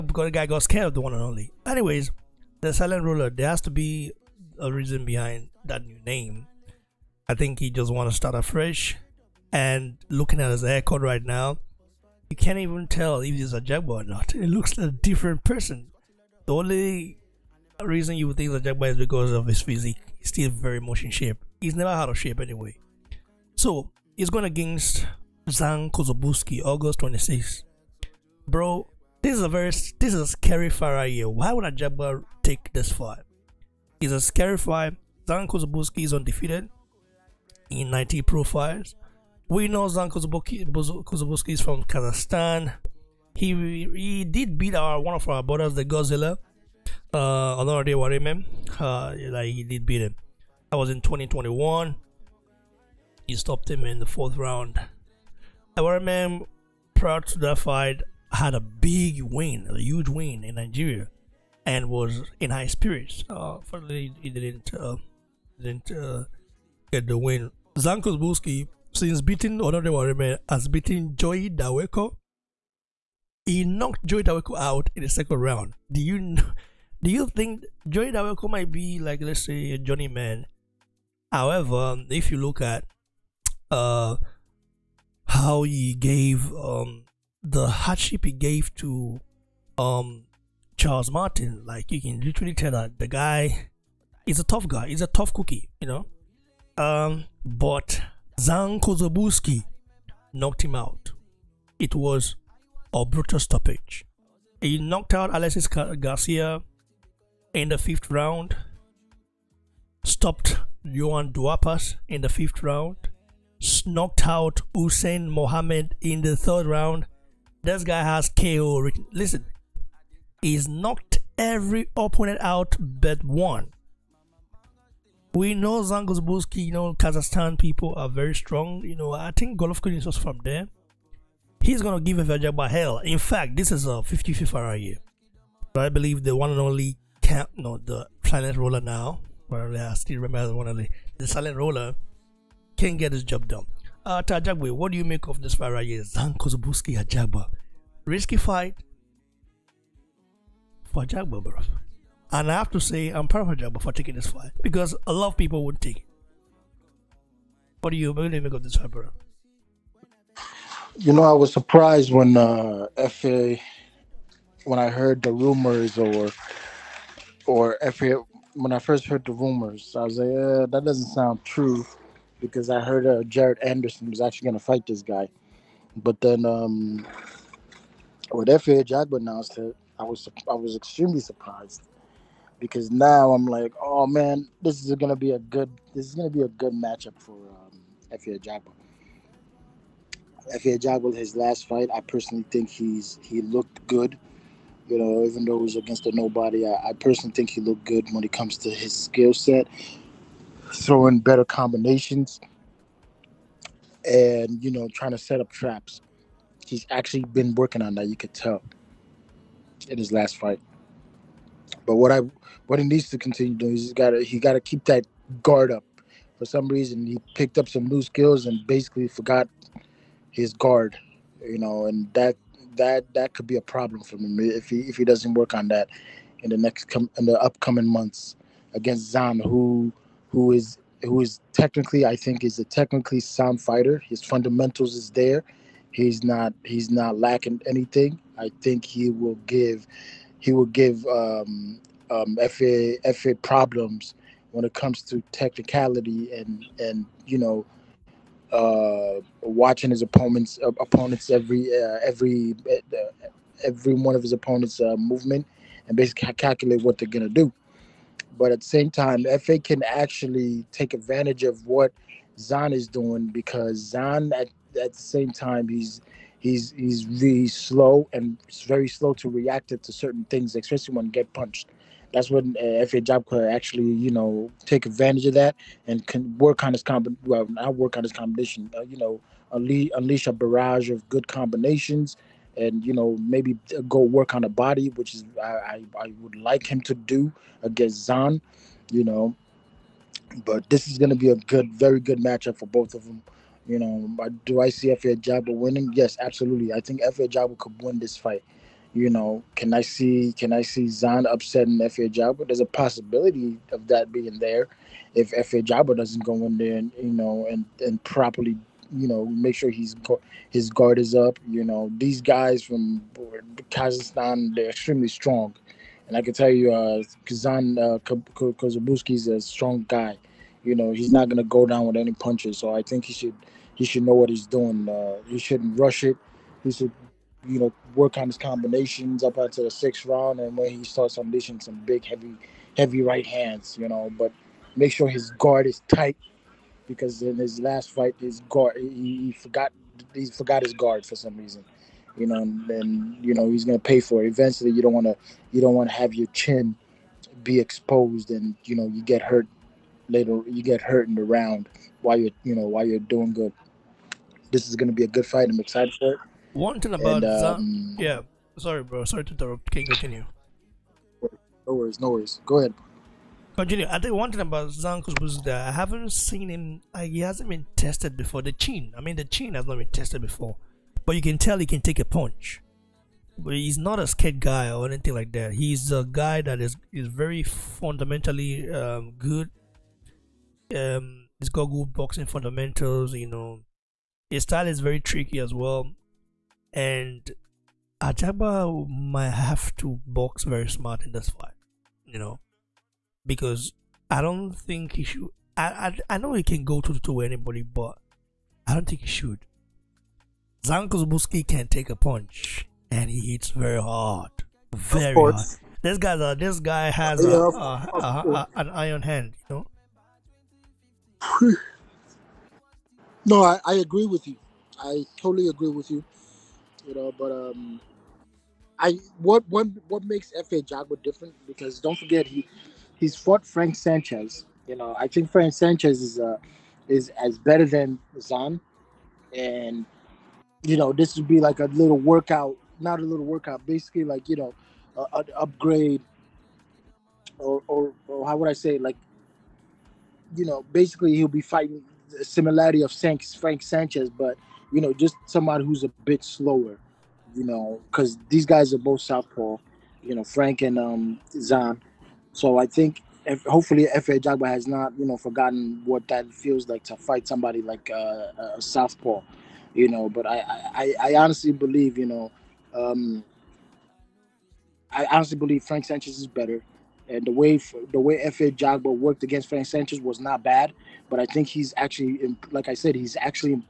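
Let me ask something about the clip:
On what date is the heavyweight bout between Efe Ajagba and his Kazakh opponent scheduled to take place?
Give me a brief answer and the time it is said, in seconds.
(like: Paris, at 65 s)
August 26, at 26 s.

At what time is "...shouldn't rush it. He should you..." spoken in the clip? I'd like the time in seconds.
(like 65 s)
325 s.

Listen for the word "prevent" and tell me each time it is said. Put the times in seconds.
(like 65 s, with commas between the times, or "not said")
not said.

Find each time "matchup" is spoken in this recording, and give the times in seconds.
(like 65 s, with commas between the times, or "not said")
186 s, 292 s.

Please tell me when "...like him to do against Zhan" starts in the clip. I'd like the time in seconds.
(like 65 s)
286 s.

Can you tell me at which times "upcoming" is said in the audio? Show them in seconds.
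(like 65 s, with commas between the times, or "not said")
227 s.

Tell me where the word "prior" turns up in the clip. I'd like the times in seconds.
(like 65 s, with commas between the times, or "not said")
56 s.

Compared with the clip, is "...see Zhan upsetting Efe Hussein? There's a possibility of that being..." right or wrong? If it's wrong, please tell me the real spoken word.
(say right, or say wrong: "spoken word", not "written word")
wrong: "Ajagba", not "Hussein".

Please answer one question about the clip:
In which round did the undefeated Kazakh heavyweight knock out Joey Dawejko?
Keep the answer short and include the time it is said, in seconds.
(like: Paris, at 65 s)
Second round, at 75 s.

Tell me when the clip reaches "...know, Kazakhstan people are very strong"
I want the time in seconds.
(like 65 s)
126 s.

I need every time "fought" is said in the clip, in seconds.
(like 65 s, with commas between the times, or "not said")
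423 s.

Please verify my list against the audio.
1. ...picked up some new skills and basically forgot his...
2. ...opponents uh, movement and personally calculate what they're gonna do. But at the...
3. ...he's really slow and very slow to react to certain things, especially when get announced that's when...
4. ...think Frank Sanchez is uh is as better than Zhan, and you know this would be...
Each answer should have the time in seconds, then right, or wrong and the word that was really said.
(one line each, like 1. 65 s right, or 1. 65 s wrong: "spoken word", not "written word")
1. 217 s right
2. 254 s wrong: "basically", not "personally"
3. 266 s wrong: "punched", not "announced"
4. 425 s right.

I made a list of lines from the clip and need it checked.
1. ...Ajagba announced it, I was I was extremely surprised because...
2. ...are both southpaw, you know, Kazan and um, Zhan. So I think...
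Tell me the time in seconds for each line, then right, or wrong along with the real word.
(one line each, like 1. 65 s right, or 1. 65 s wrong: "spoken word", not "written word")
1. 178 s right
2. 448 s wrong: "Frank", not "Kazan".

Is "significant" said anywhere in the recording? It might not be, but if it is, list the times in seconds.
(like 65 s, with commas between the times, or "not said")
not said.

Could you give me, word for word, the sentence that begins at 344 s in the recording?
Eventually, you don't want to you don't want to have your chin be exposed and you know you get hurt later.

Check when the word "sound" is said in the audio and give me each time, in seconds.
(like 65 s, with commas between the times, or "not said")
171 s, 233 s.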